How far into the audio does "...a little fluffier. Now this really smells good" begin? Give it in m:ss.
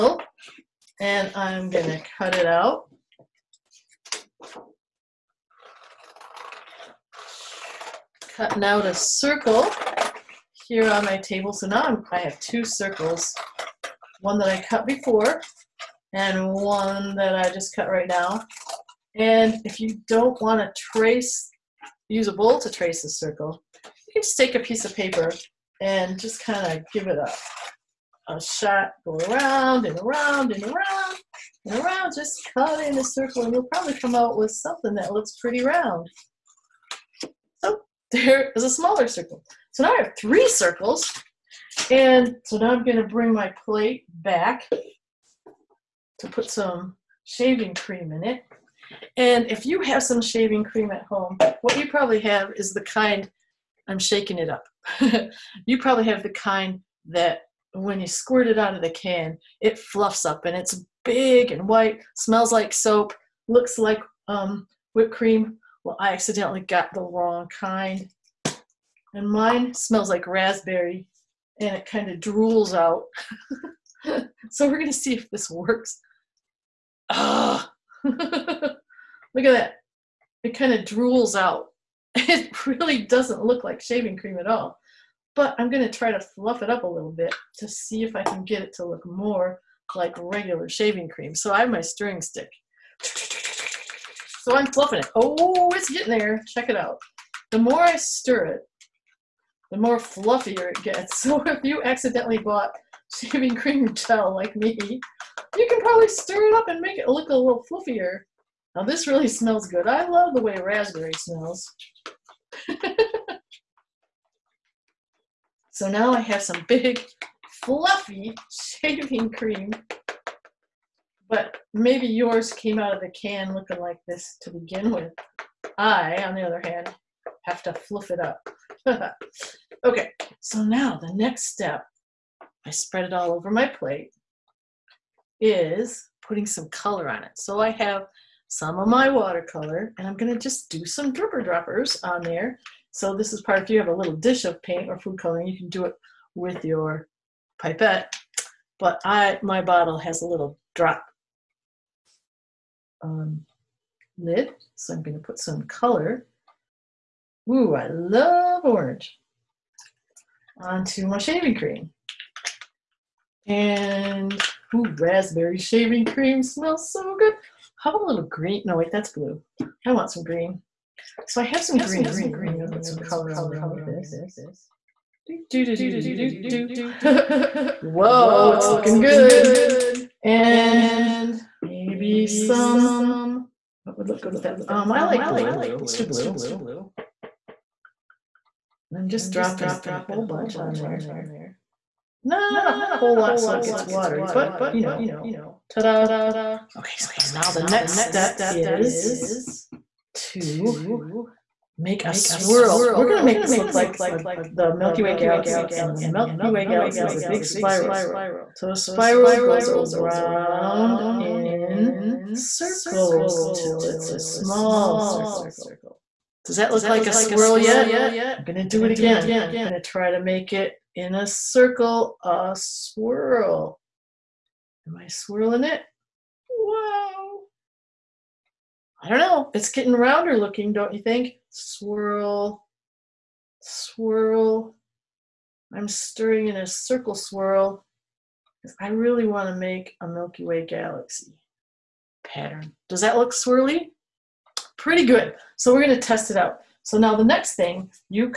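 1:47.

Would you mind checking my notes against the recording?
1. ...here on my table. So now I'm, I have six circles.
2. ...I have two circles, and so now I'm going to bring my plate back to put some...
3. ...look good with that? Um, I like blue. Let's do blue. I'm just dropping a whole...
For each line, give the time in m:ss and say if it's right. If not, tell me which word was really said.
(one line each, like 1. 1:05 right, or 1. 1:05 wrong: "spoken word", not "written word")
1. 0:10 wrong: "two", not "six"
2. 0:39 wrong: "three", not "two"
3. 3:04 right.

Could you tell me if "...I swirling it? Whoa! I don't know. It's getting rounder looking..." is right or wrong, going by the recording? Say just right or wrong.
right.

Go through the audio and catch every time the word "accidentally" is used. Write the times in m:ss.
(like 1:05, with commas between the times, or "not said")
1:06, 1:41.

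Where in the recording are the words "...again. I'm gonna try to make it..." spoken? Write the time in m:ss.
3:38.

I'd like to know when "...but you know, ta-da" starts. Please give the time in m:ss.
3:14.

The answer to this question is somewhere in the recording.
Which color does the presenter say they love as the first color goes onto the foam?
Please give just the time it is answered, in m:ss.
2:38.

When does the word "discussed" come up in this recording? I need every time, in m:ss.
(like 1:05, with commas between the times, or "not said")
not said.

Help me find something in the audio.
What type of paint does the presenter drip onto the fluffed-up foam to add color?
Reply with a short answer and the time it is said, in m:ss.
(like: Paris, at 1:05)
Watercolor, at 2:19.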